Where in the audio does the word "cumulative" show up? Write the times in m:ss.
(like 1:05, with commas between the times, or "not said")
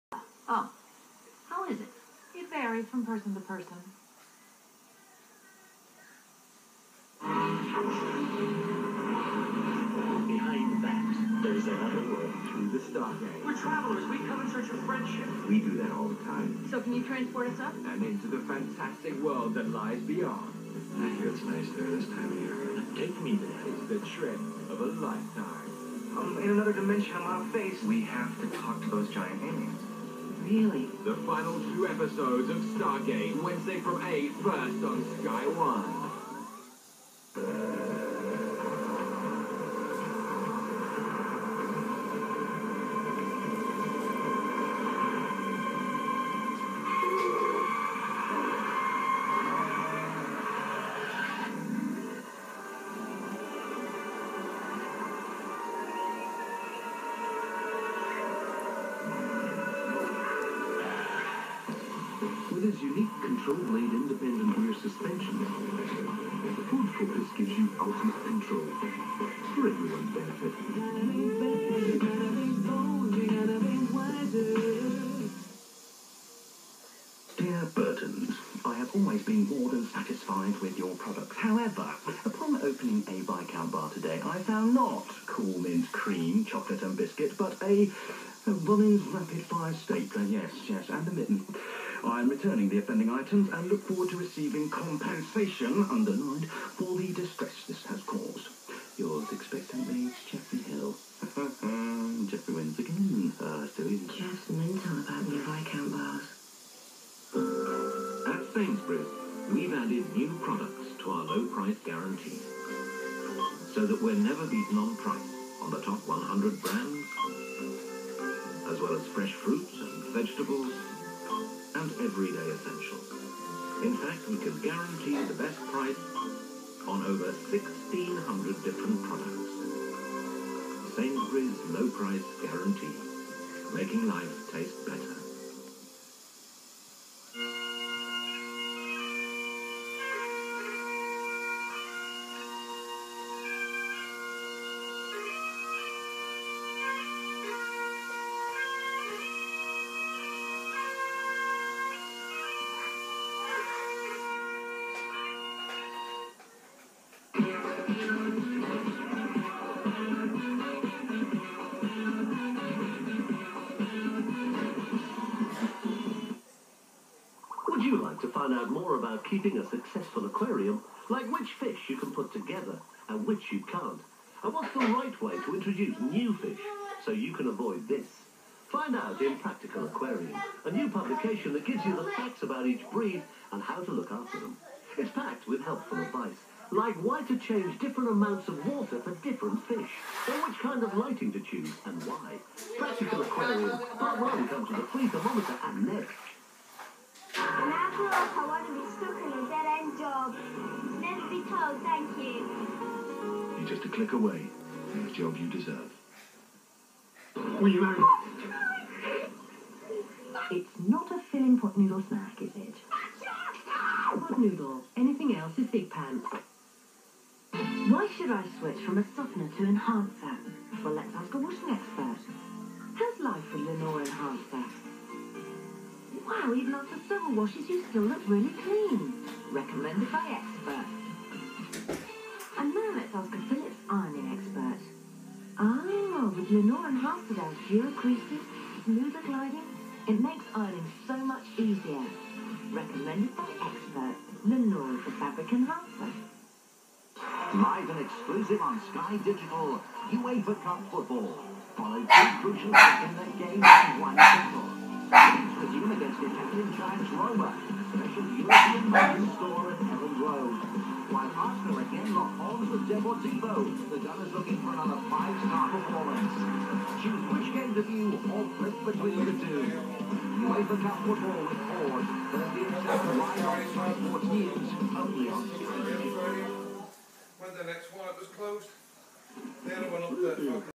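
not said.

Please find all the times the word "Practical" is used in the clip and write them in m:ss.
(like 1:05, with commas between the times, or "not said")
2:59, 3:12.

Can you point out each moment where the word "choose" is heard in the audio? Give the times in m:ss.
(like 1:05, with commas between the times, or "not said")
3:11, 4:27.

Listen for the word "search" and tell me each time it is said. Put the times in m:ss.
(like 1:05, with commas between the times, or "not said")
0:14.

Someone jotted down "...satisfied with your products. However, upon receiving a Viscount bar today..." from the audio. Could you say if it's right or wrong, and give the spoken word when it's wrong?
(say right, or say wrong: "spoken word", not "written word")
wrong: "opening", not "receiving".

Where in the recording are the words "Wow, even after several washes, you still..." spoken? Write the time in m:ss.
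3:46.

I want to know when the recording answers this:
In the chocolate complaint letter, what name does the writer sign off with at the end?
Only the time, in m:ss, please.
1:40.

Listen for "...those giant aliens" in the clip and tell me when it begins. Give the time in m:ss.
0:28.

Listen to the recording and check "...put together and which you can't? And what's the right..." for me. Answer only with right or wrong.
right.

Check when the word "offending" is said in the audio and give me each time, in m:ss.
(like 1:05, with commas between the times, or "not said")
1:32.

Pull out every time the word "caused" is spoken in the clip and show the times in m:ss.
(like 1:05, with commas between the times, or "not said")
1:38.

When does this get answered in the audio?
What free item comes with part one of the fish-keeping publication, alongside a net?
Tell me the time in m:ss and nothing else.
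3:15.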